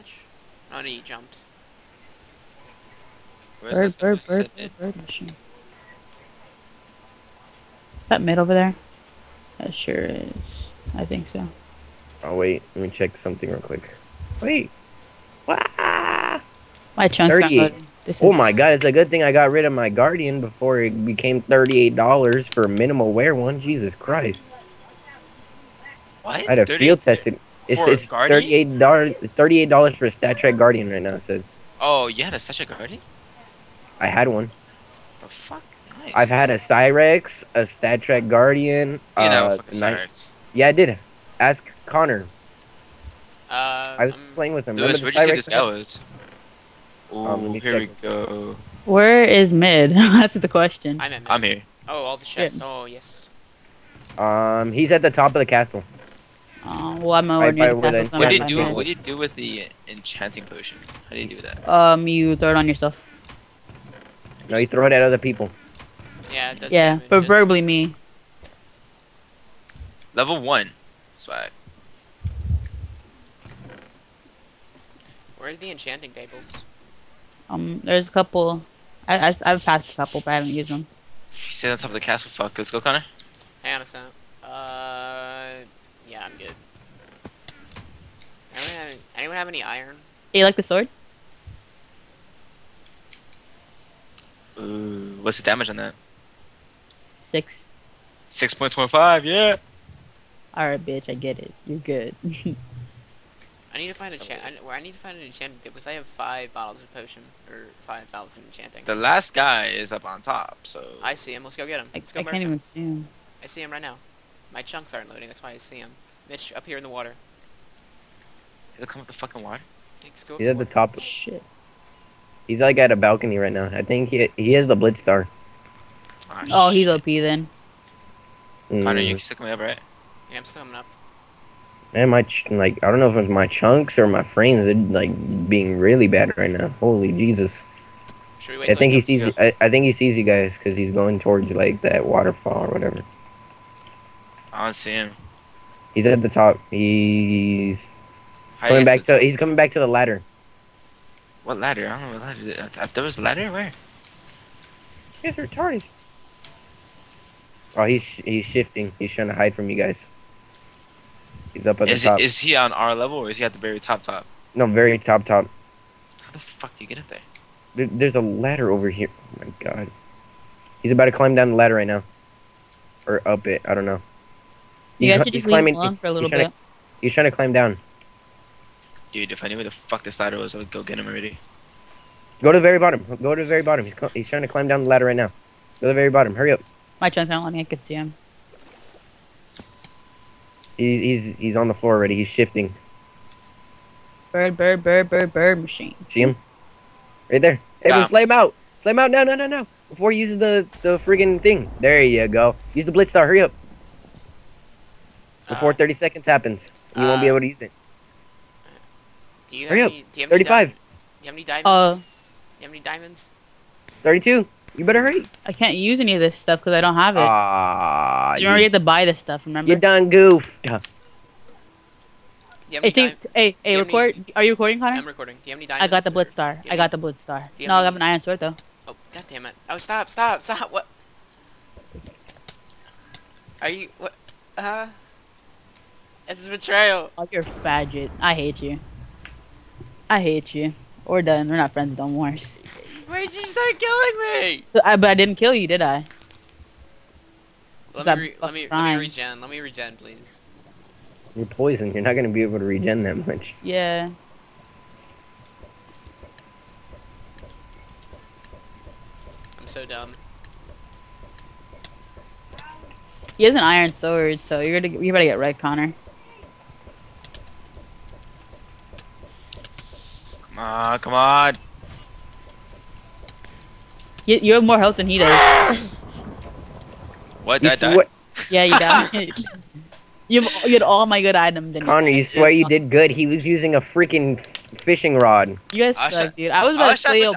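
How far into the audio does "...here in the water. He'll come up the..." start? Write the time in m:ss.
1:56.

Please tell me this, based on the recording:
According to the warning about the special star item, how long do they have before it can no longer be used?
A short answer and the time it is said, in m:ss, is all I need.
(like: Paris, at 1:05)
30 seconds, at 3:25.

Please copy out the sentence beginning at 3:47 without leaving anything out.
No, I have an Iron Sword, though.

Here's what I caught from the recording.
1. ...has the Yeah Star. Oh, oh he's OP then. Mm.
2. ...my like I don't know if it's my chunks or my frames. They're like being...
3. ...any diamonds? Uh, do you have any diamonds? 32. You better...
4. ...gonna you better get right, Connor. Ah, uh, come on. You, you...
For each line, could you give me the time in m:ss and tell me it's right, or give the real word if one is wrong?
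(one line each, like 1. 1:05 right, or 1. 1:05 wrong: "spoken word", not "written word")
1. 2:04 wrong: "Blitz", not "Yeah"
2. 2:12 right
3. 3:31 right
4. 4:24 right.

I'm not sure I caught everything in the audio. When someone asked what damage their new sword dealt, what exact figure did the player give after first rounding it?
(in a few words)
6.25.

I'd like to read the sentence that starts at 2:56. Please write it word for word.
To, he's trying to climb down.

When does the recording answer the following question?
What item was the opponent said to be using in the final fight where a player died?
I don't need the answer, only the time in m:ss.
4:44.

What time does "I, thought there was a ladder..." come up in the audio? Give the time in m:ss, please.
2:32.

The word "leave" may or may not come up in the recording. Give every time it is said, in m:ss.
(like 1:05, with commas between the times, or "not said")
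2:55.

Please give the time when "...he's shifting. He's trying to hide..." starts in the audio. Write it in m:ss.
2:38.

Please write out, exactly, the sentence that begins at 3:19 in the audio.
Before he uses the, the friggin' thing.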